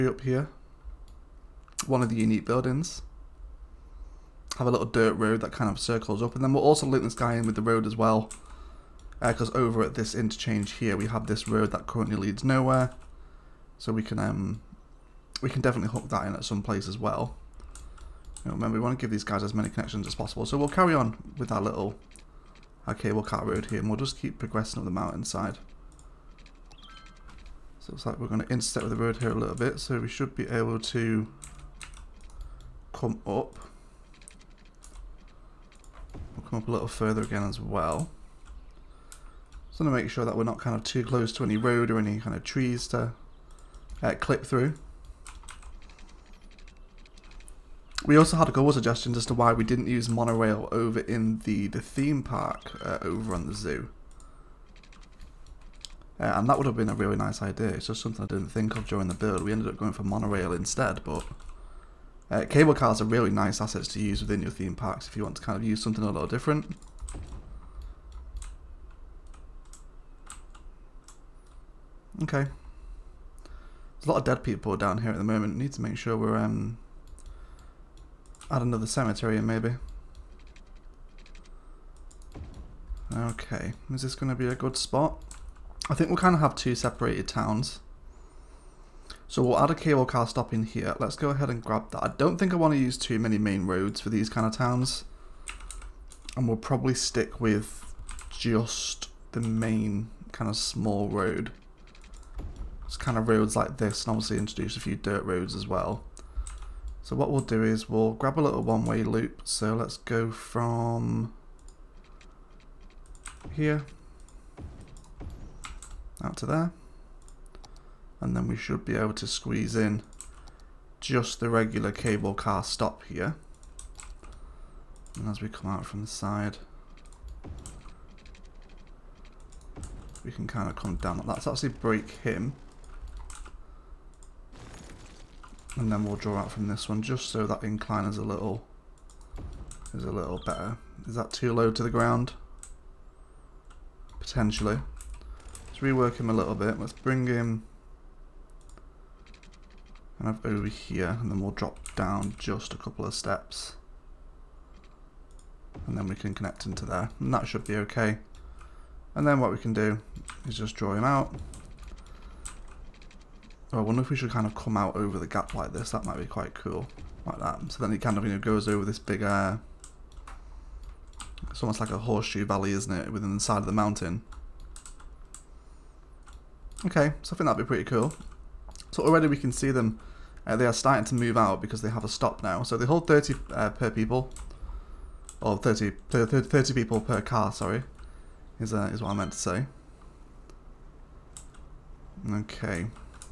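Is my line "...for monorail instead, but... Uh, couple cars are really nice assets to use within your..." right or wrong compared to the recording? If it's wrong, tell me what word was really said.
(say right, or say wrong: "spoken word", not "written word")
wrong: "cable", not "couple".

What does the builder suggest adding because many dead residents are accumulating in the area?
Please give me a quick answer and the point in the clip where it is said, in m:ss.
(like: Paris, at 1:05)
Another cemetery, at 1:18.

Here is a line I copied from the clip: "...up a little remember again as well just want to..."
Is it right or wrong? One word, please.
wrong.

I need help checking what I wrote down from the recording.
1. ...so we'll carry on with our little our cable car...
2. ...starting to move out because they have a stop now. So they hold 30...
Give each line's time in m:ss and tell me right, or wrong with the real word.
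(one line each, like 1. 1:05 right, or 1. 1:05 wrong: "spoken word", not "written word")
1. 0:20 right
2. 3:00 right.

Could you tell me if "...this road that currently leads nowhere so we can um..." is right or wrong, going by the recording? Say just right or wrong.
right.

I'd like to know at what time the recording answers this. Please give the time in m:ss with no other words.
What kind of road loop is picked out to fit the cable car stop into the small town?
1:48.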